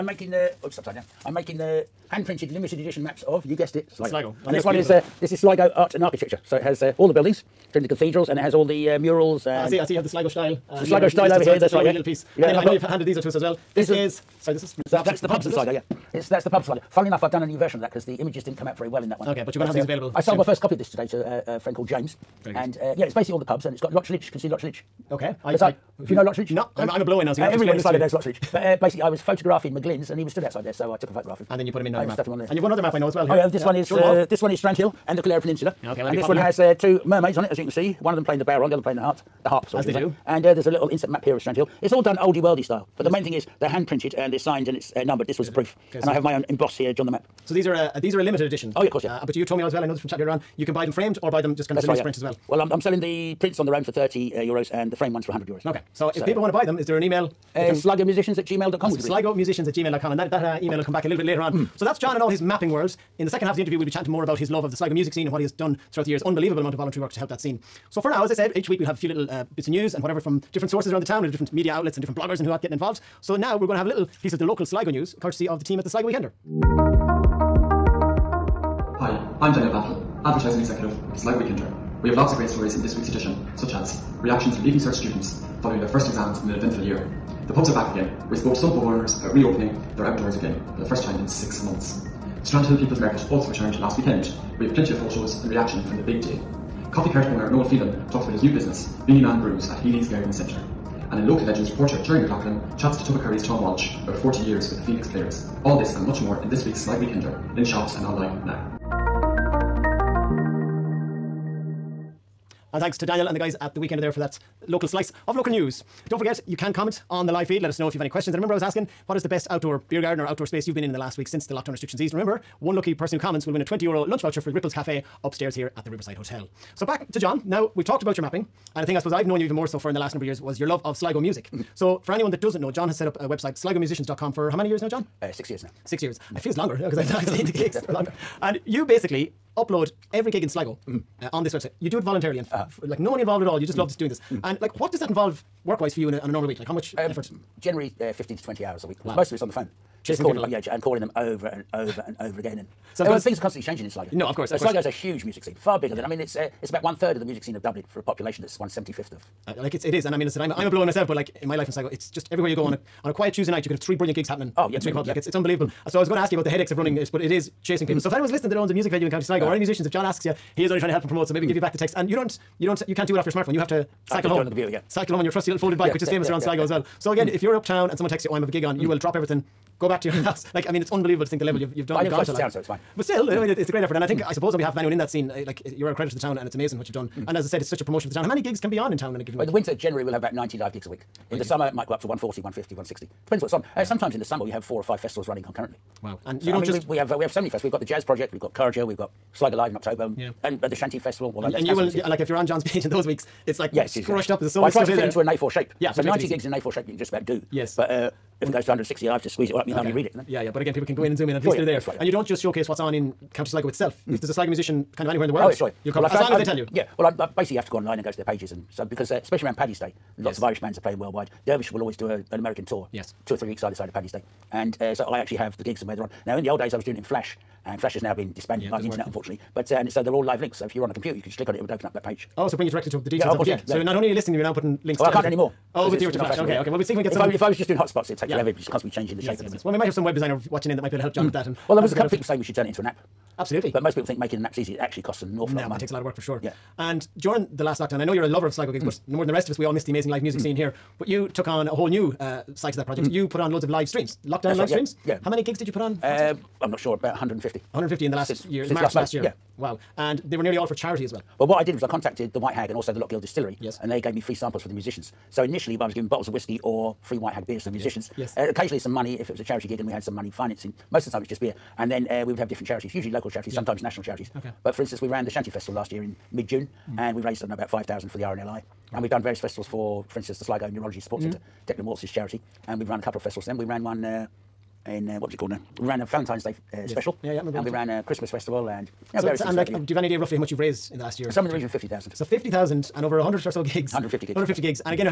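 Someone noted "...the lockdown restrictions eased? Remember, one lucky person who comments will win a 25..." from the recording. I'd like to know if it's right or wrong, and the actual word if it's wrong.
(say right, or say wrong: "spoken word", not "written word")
wrong: "20", not "25".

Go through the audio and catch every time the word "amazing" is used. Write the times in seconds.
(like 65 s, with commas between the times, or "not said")
186 s, 249 s.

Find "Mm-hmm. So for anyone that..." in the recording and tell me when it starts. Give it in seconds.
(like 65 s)
131 s.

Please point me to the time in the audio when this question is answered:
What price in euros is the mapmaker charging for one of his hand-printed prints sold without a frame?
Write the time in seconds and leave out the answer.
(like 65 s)
53 s.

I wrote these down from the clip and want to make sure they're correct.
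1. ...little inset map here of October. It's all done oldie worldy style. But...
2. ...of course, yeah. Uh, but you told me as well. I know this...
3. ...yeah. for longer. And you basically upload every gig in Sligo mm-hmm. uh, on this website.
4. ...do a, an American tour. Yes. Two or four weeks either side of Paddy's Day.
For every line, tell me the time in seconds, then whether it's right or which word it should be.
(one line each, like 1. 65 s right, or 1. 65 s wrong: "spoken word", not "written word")
1. 40 s wrong: "Strandhill", not "October"
2. 48 s right
3. 137 s right
4. 221 s wrong: "three", not "four".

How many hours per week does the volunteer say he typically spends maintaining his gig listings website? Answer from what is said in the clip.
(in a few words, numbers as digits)
15 to 20 hours.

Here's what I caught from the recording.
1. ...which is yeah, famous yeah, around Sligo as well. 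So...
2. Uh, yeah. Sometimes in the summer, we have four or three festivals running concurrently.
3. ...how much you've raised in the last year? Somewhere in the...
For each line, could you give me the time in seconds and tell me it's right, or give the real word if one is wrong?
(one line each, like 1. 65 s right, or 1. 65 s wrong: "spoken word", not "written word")
1. 175 s right
2. 193 s wrong: "five", not "three"
3. 290 s right.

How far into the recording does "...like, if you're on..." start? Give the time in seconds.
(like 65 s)
202 s.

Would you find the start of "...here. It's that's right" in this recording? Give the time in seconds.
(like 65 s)
11 s.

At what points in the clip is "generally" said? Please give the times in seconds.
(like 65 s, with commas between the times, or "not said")
147 s, 189 s.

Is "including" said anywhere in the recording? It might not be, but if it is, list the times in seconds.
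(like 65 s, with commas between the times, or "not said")
7 s.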